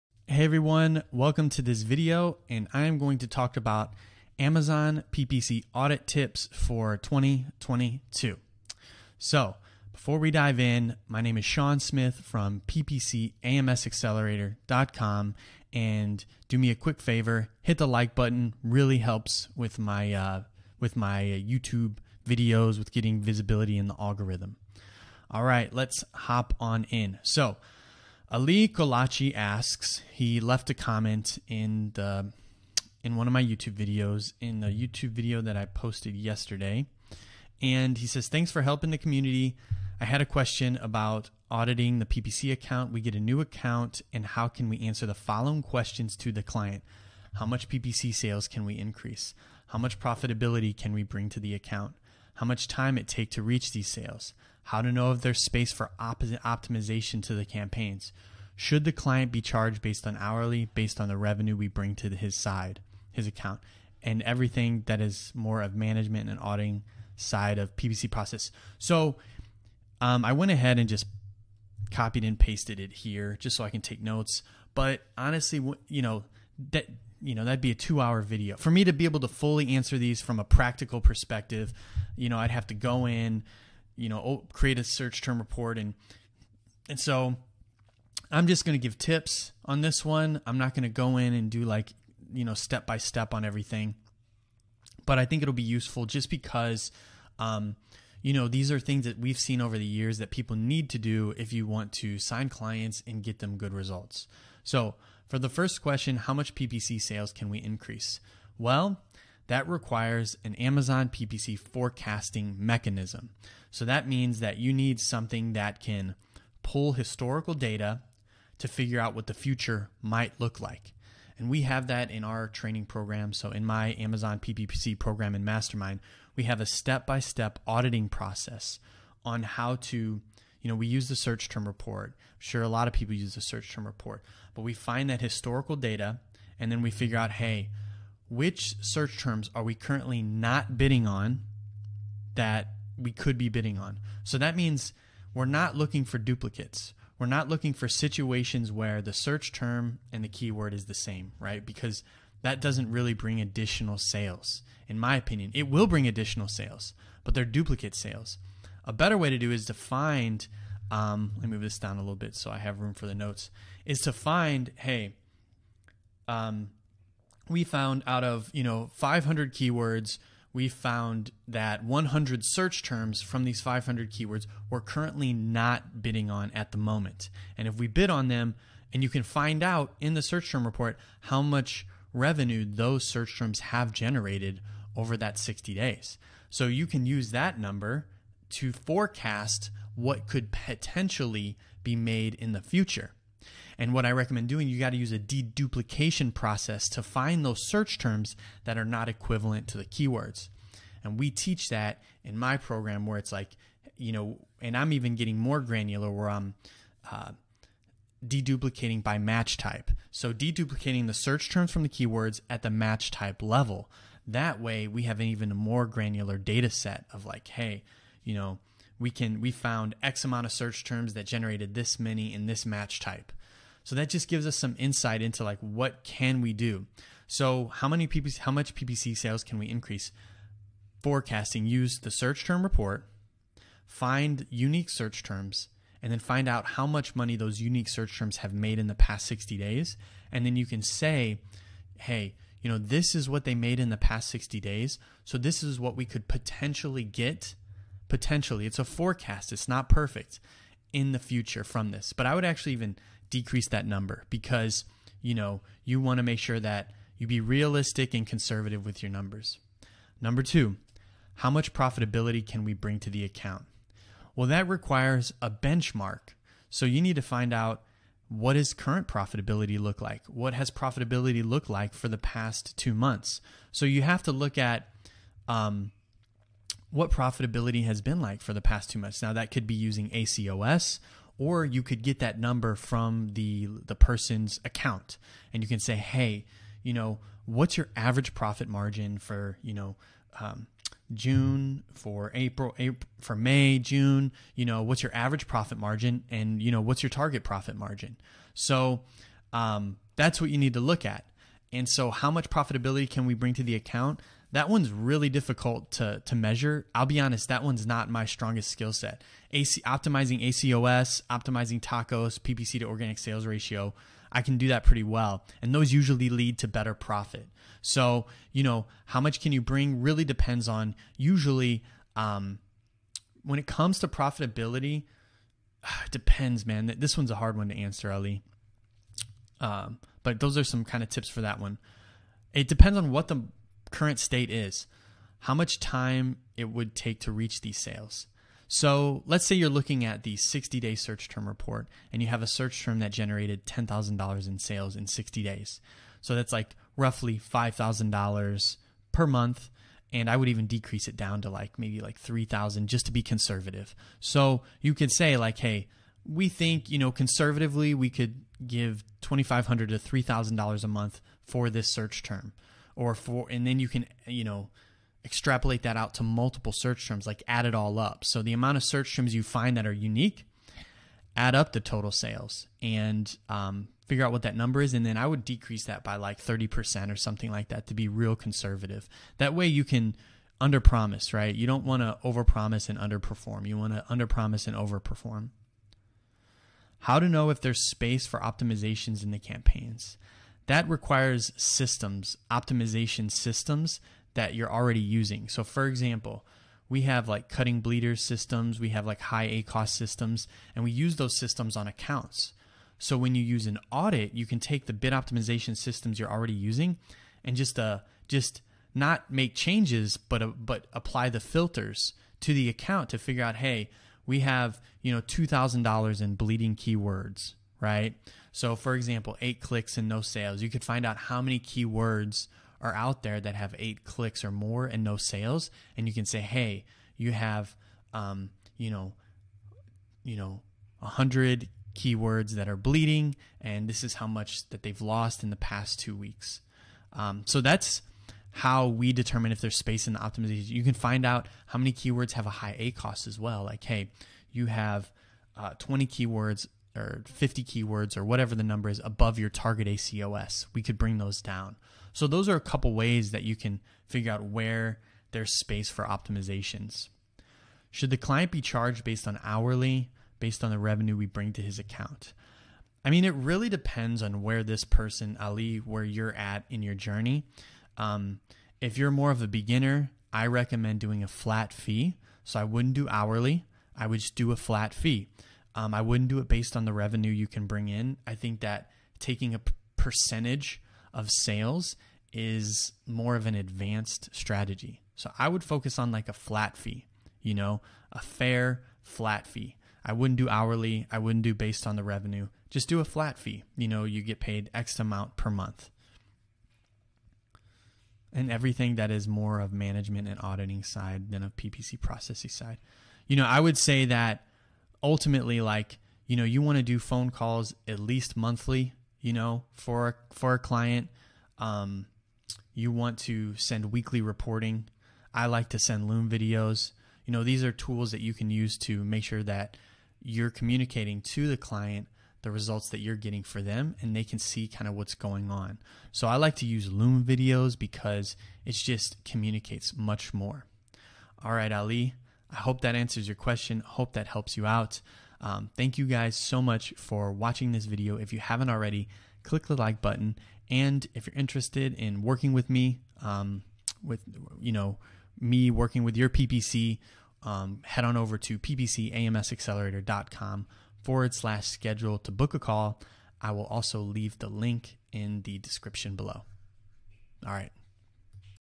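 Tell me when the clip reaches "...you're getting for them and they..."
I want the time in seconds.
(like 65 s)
522 s.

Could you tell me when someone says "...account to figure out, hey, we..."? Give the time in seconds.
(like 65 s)
412 s.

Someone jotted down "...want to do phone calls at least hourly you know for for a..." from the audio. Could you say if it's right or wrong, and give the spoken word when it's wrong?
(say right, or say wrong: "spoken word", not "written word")
wrong: "monthly", not "hourly".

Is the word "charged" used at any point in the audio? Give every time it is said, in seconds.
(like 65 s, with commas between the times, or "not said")
59 s, 458 s.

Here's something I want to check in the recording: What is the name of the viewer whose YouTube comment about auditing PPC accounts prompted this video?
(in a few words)
Ali Kolachi.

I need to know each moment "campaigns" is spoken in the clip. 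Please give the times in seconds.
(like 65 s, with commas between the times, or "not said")
57 s, 389 s.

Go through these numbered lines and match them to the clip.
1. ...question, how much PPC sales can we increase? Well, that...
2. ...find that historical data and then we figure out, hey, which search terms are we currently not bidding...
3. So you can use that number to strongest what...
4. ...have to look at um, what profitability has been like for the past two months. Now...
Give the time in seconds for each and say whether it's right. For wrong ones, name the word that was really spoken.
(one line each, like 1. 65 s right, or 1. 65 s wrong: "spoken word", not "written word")
1. 105 s right
2. 134 s right
3. 186 s wrong: "forecast", not "strongest"
4. 274 s right.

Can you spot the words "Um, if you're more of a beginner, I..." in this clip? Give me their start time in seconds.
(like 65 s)
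467 s.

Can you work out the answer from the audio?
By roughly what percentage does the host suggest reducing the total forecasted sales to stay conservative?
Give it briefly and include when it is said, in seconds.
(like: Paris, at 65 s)
30%, at 376 s.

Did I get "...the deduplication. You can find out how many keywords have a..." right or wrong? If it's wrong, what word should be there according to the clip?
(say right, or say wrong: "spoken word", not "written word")
wrong: "optimization", not "deduplication".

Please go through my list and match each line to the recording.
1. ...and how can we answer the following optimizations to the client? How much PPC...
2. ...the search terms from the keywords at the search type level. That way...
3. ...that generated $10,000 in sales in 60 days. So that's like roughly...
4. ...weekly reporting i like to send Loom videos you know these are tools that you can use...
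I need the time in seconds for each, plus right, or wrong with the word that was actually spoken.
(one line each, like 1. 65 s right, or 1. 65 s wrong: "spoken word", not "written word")
1. 44 s wrong: "questions", not "optimizations"
2. 211 s wrong: "match", not "search"
3. 342 s right
4. 513 s right.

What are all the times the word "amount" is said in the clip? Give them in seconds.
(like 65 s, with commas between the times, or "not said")
220 s, 368 s, 494 s.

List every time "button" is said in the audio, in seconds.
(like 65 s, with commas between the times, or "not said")
18 s, 540 s.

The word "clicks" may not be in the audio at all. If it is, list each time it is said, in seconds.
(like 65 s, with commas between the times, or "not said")
419 s, 424 s, 539 s.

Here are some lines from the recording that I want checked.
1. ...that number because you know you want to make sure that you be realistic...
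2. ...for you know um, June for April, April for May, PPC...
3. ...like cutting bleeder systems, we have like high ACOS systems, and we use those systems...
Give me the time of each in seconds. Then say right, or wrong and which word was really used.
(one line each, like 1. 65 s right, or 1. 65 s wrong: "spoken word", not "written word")
1. 253 s right
2. 289 s wrong: "June", not "PPC"
3. 397 s right.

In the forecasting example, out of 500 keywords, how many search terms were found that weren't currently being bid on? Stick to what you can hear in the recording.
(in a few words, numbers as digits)
100.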